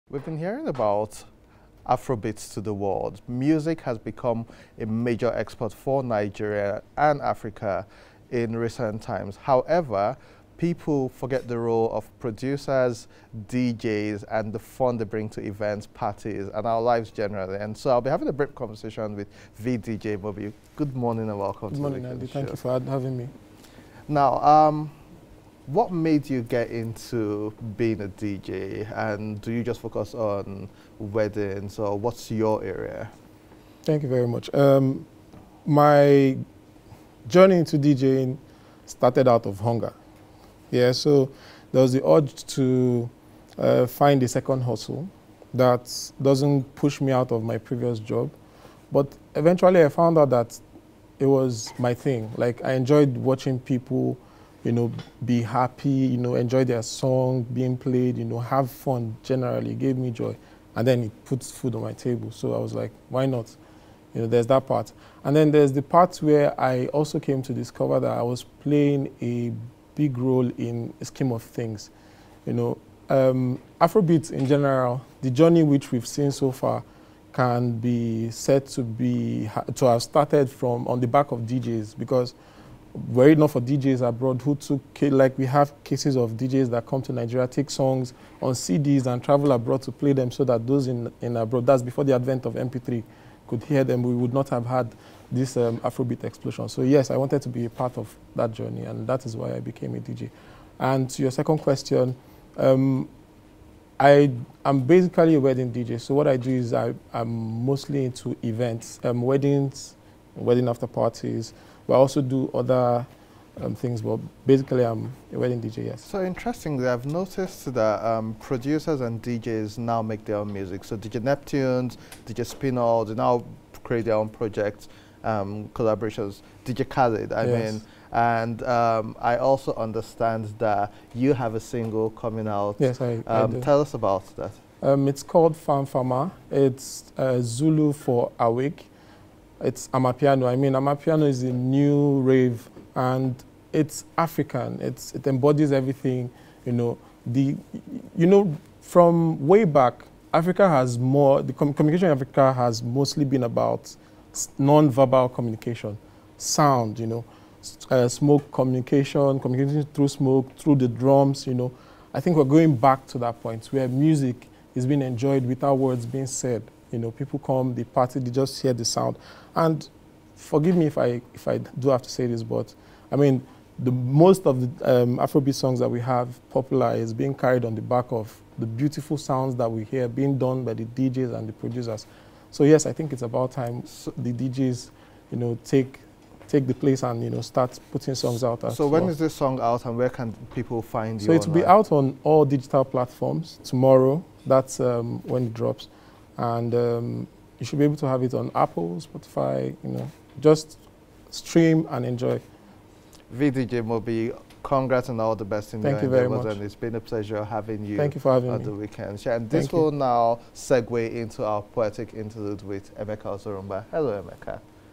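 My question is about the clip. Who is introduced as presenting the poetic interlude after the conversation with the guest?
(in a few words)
Emeka Zorumba.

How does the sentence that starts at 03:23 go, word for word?
VDJ Mobi, congrats and all the best in Thank your you very much.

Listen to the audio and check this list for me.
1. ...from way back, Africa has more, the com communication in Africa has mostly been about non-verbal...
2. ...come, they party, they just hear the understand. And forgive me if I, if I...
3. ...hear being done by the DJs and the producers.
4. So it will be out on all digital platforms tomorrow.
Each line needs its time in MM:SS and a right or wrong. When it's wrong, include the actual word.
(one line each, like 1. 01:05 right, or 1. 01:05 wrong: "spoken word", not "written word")
1. 02:28 right
2. 02:47 wrong: "sound", not "understand"
3. 02:59 right
4. 03:11 right.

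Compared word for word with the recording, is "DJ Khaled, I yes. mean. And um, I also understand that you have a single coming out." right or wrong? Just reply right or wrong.
right.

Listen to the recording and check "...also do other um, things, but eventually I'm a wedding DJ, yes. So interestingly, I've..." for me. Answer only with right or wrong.
wrong.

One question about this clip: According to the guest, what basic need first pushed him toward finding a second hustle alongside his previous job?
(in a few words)
Hunger.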